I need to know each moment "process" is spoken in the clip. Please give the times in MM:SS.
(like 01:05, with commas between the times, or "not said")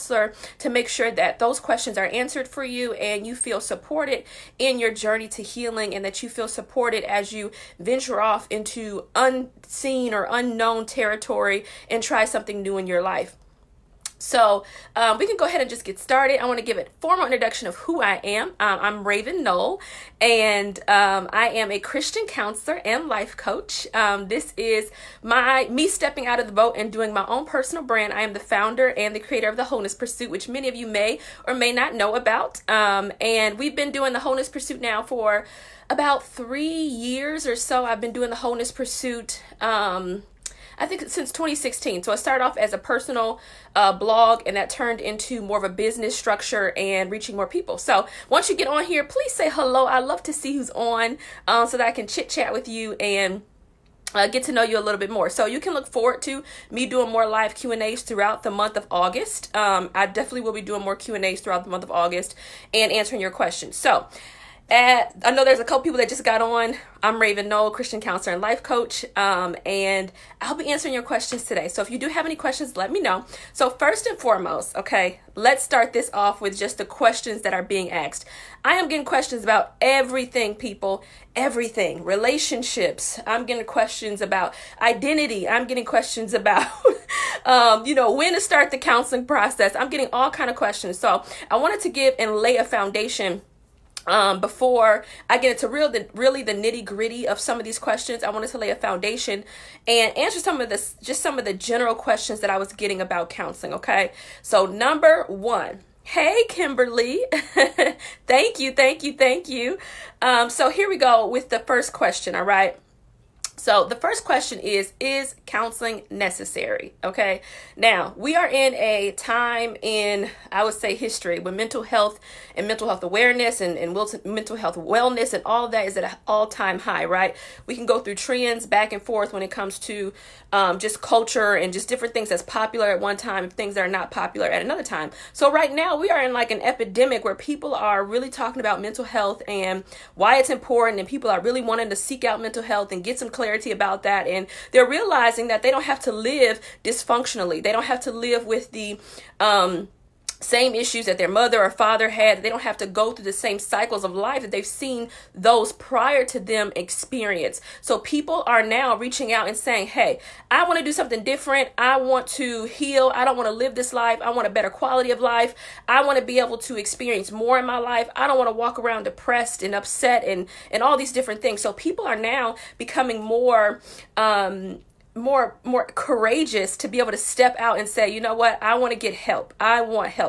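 01:29.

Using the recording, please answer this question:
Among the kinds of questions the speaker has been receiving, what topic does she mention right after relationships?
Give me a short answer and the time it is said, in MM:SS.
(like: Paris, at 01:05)
Identity, at 01:24.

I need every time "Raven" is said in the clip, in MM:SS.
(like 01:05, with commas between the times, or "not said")
00:19, 01:07.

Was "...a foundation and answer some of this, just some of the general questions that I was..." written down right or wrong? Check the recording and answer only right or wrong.
right.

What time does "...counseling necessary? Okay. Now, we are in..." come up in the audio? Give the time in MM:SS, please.
01:55.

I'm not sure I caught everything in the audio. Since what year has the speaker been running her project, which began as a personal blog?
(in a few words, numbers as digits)
2016.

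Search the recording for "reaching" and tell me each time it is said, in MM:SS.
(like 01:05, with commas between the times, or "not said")
00:47, 02:38.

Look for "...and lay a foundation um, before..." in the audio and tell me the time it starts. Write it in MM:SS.
01:32.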